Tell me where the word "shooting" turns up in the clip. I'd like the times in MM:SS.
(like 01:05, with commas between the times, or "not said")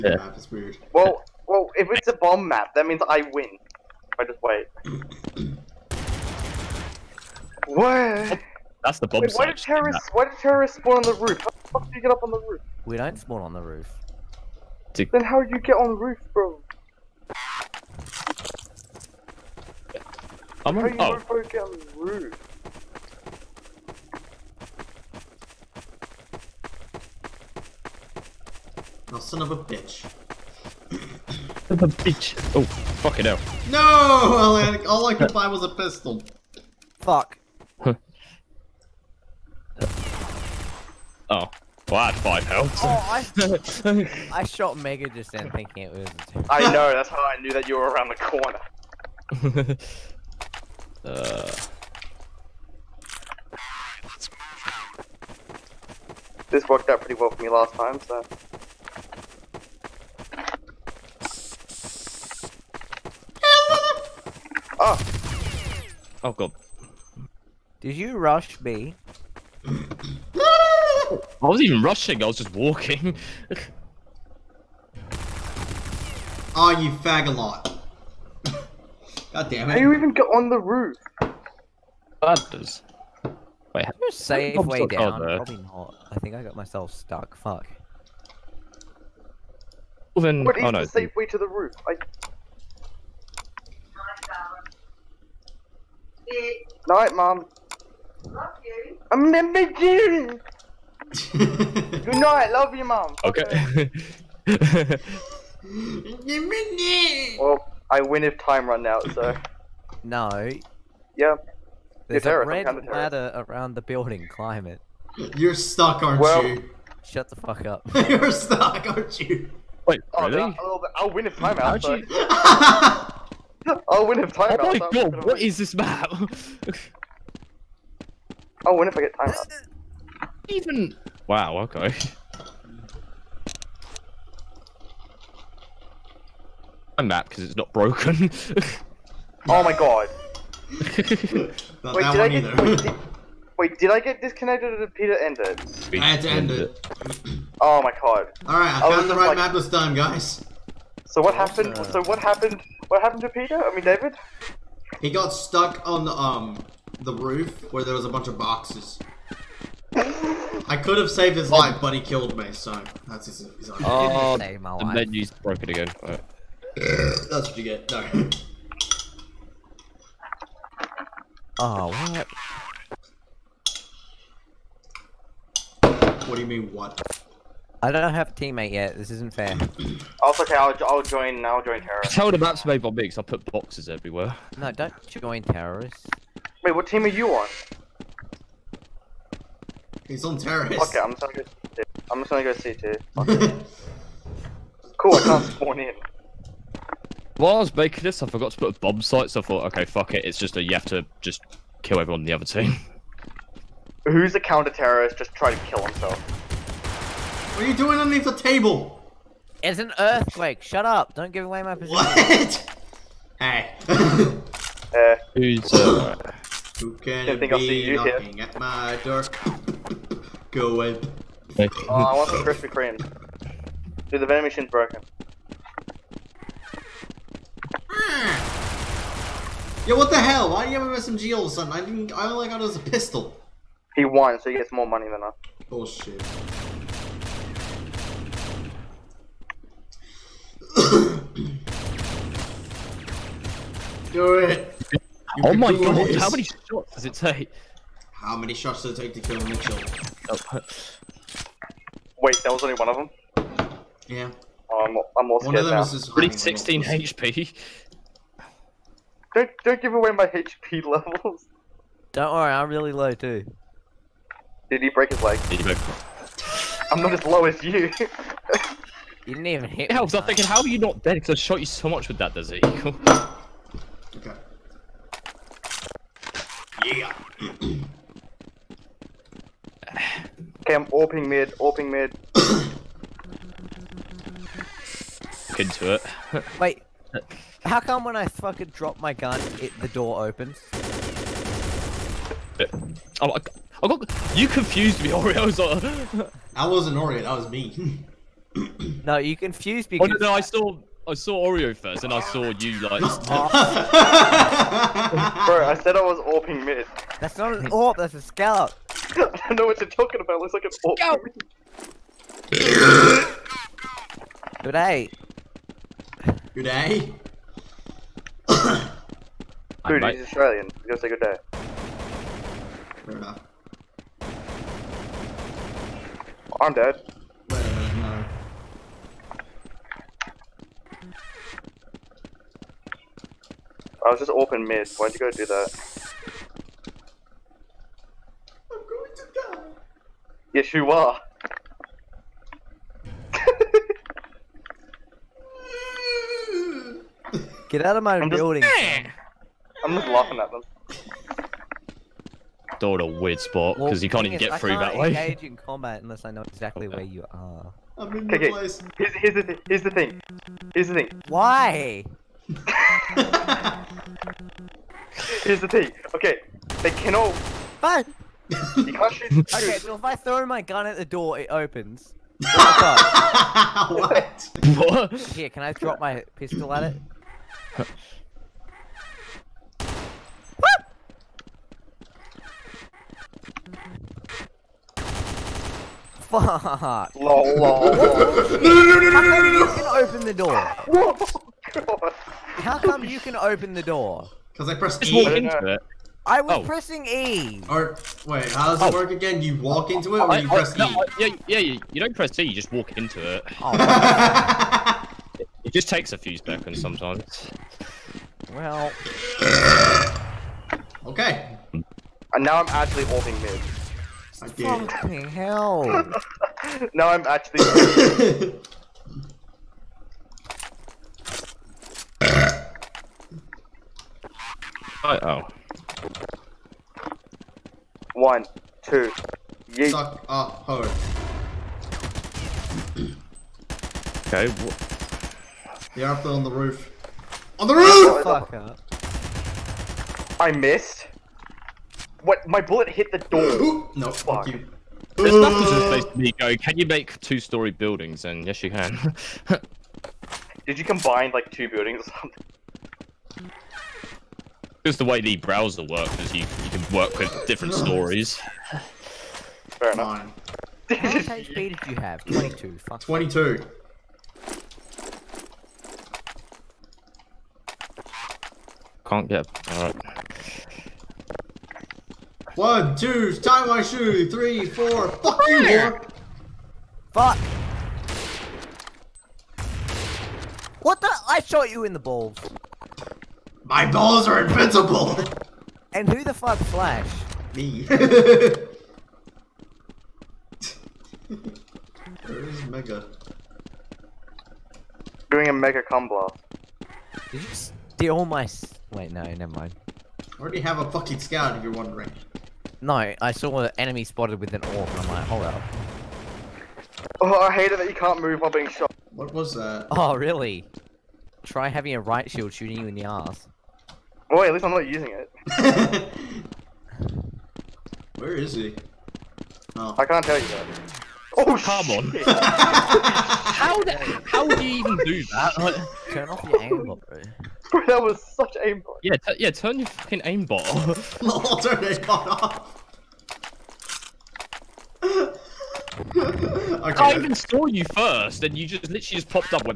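08:32.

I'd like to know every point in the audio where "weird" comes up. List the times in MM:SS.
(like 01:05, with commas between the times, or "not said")
00:00, 05:53.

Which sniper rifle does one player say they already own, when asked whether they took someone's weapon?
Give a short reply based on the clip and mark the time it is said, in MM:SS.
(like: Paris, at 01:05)
scout, at 08:21.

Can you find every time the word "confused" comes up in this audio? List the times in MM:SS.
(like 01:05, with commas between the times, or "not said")
04:54, 04:59.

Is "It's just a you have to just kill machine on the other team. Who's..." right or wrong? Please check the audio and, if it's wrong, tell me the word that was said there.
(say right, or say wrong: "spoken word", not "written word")
wrong: "everyone", not "machine".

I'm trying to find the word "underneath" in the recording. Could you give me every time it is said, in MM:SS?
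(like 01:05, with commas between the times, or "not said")
03:27.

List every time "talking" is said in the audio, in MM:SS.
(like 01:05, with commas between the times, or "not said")
05:09.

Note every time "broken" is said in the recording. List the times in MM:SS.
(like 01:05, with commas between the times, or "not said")
02:17, 02:45, 03:44.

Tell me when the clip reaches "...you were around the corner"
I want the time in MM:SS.
00:47.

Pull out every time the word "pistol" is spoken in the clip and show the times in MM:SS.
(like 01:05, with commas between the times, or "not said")
00:35, 03:52, 06:16.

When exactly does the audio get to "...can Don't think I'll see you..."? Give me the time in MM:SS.
03:36.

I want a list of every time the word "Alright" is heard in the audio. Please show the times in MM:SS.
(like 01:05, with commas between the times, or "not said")
02:28, 07:49.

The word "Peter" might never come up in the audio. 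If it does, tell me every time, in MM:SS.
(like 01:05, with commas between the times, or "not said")
02:24, 02:33.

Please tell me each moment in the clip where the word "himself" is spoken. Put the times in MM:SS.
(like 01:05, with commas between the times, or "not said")
03:25.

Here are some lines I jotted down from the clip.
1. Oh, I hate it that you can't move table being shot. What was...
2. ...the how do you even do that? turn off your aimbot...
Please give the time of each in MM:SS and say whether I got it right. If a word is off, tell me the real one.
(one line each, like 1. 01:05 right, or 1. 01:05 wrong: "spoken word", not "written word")
1. 08:27 wrong: "while", not "table"
2. 08:43 right.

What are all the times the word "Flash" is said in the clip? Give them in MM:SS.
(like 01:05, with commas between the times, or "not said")
08:06.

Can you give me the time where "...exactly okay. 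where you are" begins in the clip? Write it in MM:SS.
05:56.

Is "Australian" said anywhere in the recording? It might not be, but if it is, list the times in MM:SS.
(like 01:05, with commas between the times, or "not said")
05:20.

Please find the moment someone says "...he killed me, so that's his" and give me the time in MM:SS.
02:41.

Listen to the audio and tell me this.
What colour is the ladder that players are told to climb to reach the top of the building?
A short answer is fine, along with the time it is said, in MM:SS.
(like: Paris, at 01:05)
red, at 01:52.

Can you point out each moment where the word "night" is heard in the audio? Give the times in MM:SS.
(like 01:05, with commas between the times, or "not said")
01:36, 01:42.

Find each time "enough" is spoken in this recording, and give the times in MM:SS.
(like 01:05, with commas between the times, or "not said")
05:23, 07:39.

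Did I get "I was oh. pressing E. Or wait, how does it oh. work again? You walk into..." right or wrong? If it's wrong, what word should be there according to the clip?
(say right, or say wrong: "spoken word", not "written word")
right.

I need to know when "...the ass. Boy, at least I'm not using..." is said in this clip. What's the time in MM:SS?
08:32.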